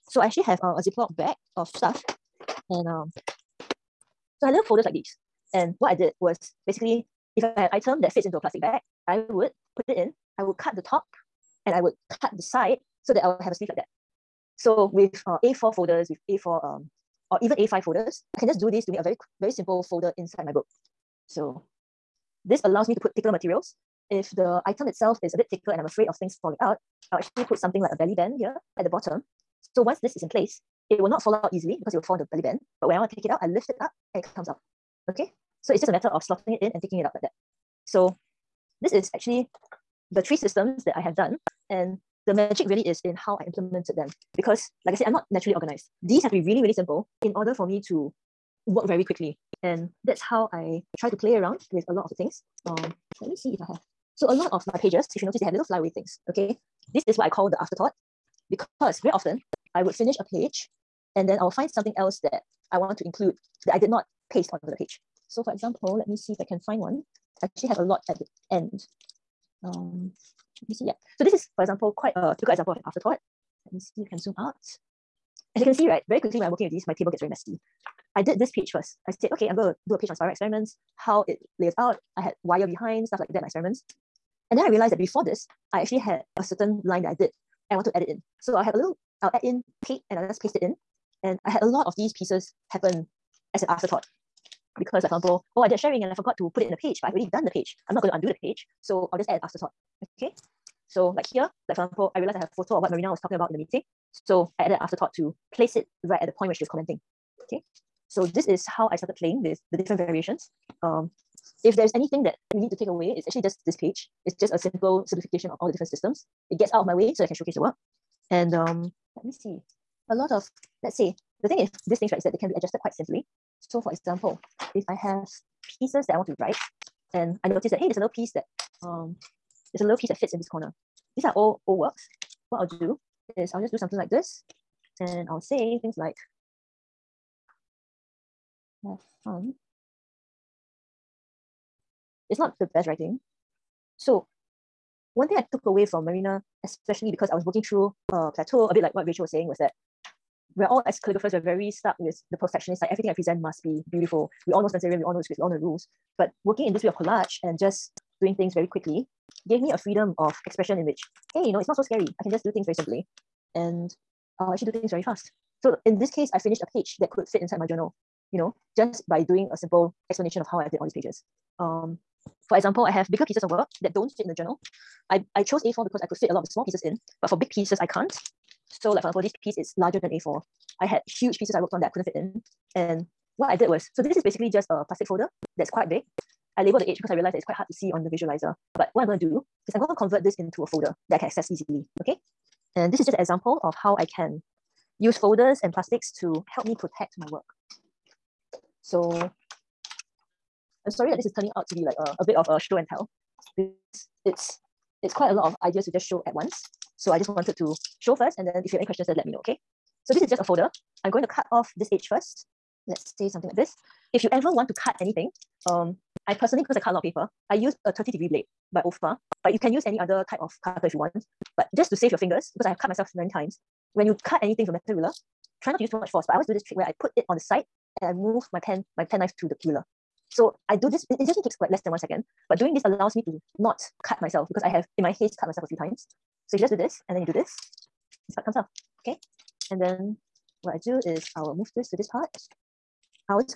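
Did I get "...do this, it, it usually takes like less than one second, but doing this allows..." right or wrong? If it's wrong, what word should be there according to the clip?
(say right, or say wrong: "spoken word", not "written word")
right.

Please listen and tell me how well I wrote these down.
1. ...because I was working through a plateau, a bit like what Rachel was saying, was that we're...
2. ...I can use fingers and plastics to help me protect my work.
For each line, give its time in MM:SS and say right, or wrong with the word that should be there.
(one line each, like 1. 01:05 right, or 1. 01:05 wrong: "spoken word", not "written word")
1. 02:27 right
2. 03:13 wrong: "folders", not "fingers".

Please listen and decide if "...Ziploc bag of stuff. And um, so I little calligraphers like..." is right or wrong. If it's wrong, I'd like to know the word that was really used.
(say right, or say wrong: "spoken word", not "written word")
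wrong: "folders", not "calligraphers".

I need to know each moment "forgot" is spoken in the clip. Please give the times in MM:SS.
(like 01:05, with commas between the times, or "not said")
01:36.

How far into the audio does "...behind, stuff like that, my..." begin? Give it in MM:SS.
01:22.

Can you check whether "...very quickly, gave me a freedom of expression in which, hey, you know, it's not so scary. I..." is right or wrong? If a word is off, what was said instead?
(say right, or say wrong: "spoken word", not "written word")
right.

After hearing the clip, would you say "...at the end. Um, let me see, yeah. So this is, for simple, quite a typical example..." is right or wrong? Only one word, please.
wrong.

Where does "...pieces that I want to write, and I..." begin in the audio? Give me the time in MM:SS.
02:05.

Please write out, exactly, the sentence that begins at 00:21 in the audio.
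So this allows me to put thicker materials.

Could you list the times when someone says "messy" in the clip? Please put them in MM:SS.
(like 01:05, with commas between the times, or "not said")
01:17.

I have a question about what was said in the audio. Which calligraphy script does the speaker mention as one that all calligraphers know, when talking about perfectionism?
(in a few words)
Spencerian.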